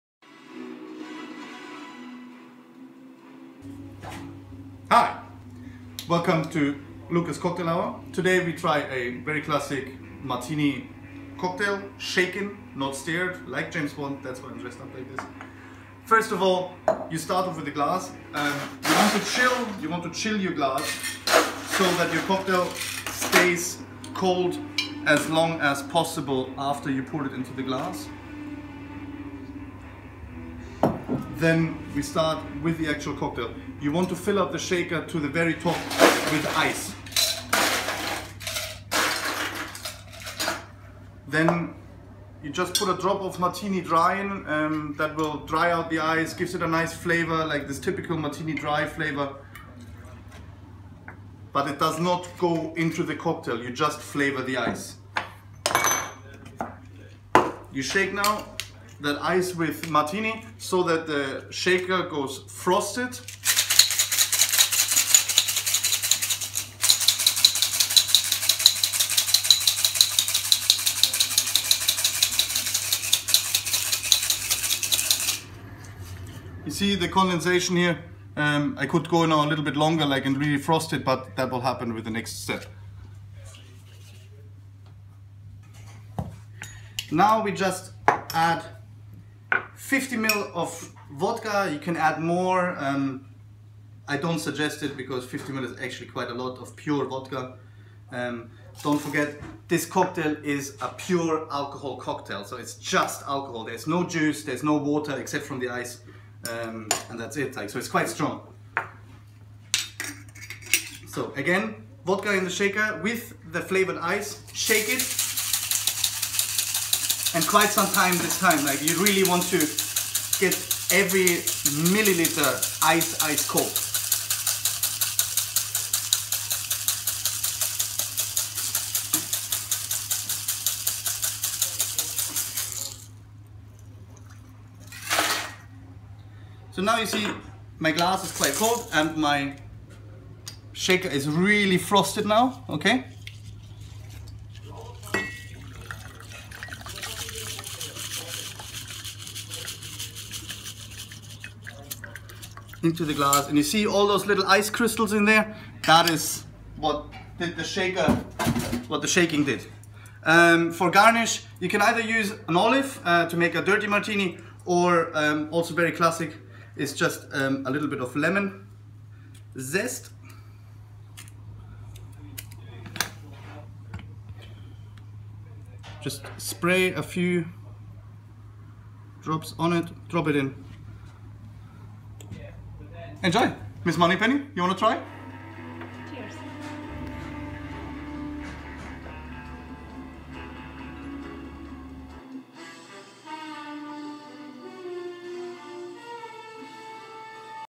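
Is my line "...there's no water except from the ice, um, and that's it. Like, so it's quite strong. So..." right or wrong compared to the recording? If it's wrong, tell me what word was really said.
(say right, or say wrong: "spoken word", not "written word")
right.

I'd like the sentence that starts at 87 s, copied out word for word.
Now we just add 50 ml of vodka, you can add more.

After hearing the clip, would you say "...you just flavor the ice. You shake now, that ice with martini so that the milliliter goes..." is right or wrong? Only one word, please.
wrong.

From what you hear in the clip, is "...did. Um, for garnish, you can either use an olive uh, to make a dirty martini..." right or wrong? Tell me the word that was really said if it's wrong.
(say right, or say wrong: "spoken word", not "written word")
right.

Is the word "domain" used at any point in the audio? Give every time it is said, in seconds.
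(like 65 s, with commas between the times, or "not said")
not said.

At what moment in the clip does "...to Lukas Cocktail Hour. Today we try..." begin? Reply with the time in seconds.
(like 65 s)
6 s.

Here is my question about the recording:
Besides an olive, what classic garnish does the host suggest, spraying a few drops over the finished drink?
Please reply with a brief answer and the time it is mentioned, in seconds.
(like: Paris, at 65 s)
lemon zest, at 168 s.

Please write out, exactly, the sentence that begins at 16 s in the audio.
First of all, you start off with a glass.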